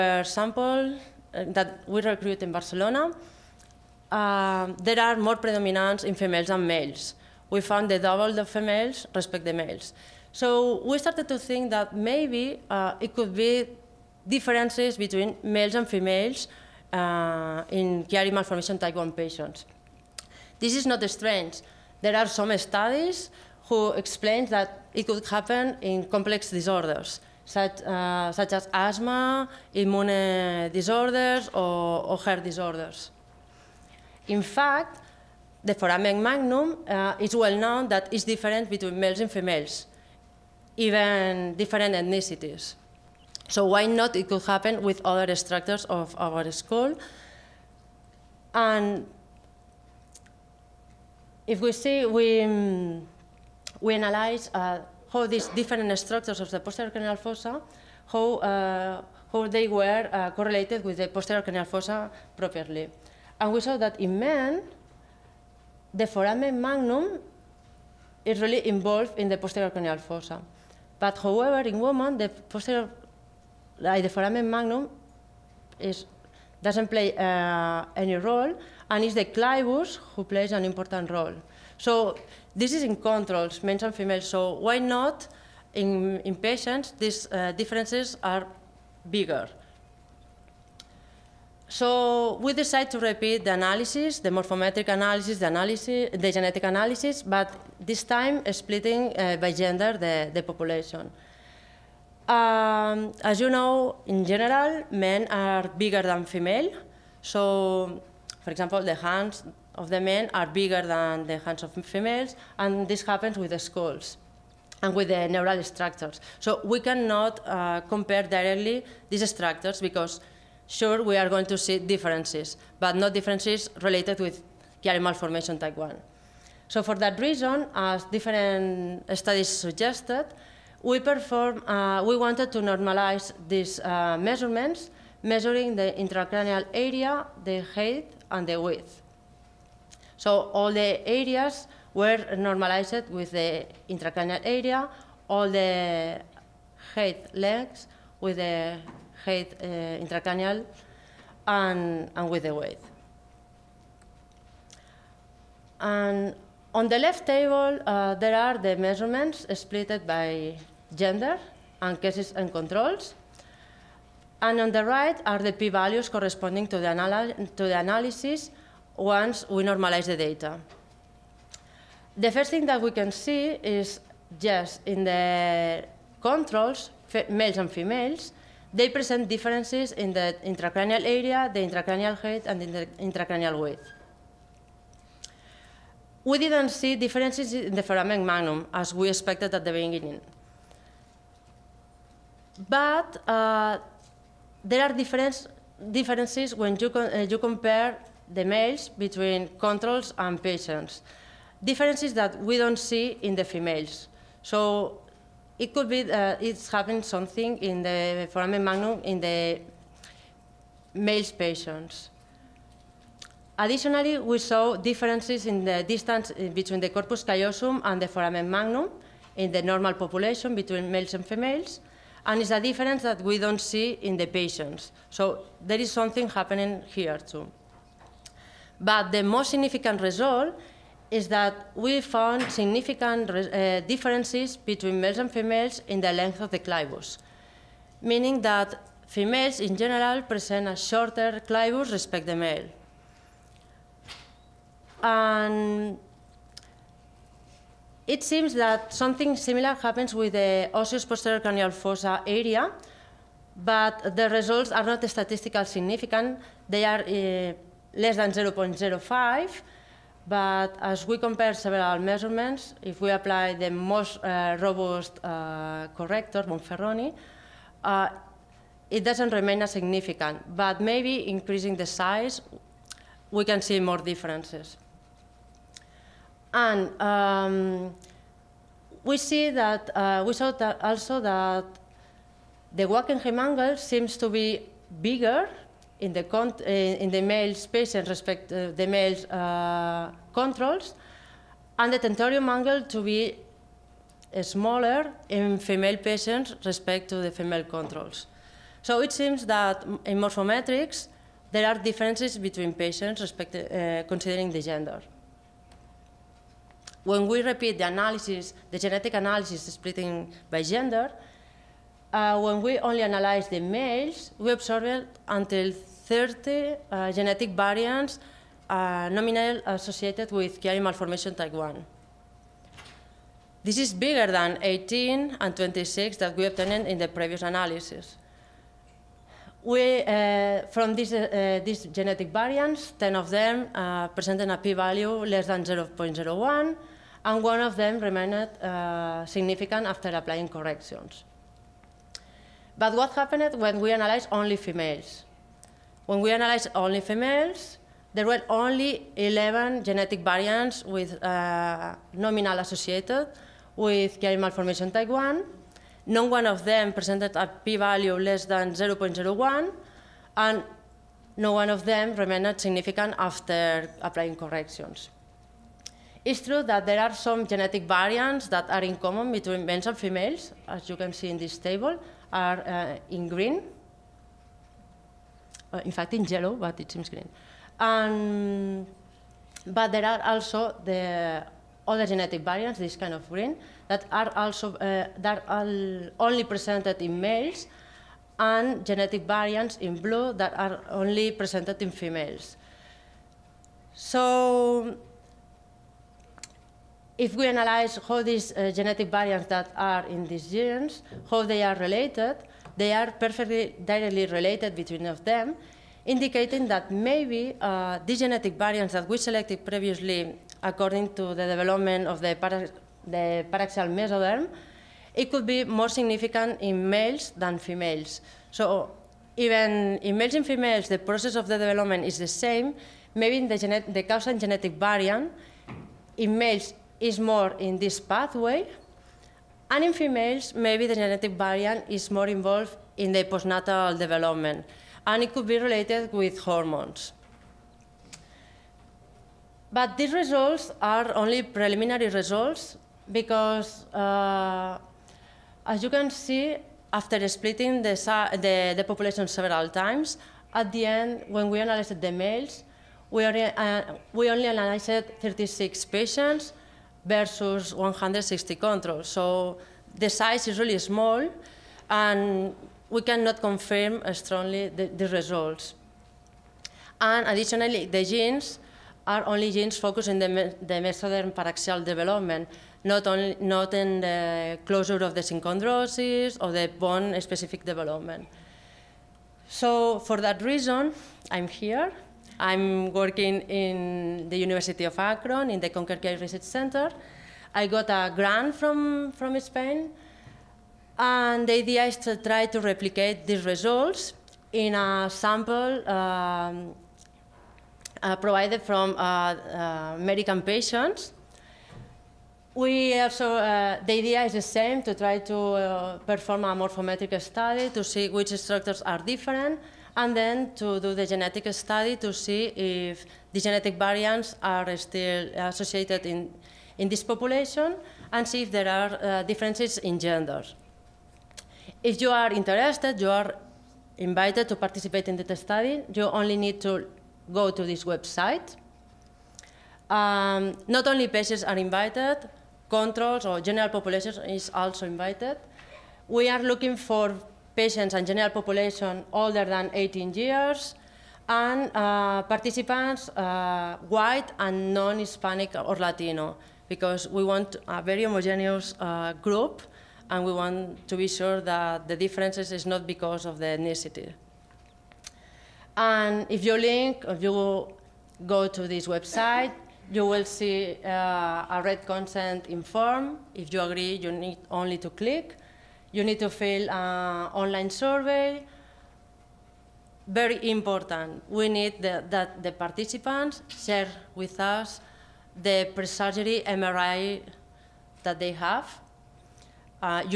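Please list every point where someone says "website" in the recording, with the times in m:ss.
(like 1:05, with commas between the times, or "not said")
8:47, 9:18.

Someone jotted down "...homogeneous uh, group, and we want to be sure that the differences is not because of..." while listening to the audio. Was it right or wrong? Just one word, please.
right.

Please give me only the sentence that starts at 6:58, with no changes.
So even in males and females, the process of the development is the same.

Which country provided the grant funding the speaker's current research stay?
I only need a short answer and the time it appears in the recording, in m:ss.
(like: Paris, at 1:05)
Spain, at 8:09.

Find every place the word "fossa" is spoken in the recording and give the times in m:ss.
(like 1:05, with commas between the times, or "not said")
0:57, 1:01, 1:09, 4:11.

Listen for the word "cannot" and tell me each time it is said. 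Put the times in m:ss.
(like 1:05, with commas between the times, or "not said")
1:56, 7:43.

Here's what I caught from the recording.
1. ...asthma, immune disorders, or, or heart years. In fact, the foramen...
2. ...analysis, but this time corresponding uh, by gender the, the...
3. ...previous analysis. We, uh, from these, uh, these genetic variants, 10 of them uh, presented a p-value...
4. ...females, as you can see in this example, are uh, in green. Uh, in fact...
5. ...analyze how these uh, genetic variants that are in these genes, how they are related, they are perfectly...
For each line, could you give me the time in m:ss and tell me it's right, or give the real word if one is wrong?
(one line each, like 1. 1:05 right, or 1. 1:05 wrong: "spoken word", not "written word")
1. 0:28 wrong: "disorders", not "years"
2. 1:36 wrong: "splitting", not "corresponding"
3. 5:27 right
4. 6:09 wrong: "table", not "example"
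5. 6:37 right.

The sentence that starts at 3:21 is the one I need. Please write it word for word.
Differences that we don't see in the females.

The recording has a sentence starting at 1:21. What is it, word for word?
So this is in controls, males and females, so why not in, in patients these uh, differences are bigger?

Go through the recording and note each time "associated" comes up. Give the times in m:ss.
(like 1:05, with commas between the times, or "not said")
5:19, 5:52, 8:35.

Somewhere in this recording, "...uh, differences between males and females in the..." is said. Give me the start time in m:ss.
3:53.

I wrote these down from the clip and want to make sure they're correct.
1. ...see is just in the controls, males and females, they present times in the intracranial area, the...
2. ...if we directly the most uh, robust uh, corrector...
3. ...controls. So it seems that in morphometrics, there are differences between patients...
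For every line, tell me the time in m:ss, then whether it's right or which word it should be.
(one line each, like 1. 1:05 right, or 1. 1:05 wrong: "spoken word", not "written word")
1. 2:53 wrong: "differences", not "times"
2. 4:22 wrong: "apply", not "directly"
3. 4:57 right.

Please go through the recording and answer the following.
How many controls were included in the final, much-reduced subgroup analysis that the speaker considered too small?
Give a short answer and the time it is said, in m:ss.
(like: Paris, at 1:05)
160, at 7:37.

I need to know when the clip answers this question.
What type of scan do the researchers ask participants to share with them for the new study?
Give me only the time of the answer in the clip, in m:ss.
9:35.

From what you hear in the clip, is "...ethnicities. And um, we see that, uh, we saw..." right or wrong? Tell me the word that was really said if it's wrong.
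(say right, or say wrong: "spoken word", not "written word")
wrong: "differences", not "ethnicities".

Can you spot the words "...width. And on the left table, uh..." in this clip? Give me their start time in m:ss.
2:32.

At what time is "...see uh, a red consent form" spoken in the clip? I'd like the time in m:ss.
9:20.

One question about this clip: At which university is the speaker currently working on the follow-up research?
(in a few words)
University of Akron.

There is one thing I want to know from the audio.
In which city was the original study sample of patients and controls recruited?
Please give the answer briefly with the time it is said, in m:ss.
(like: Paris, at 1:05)
Barcelona, at 0:02.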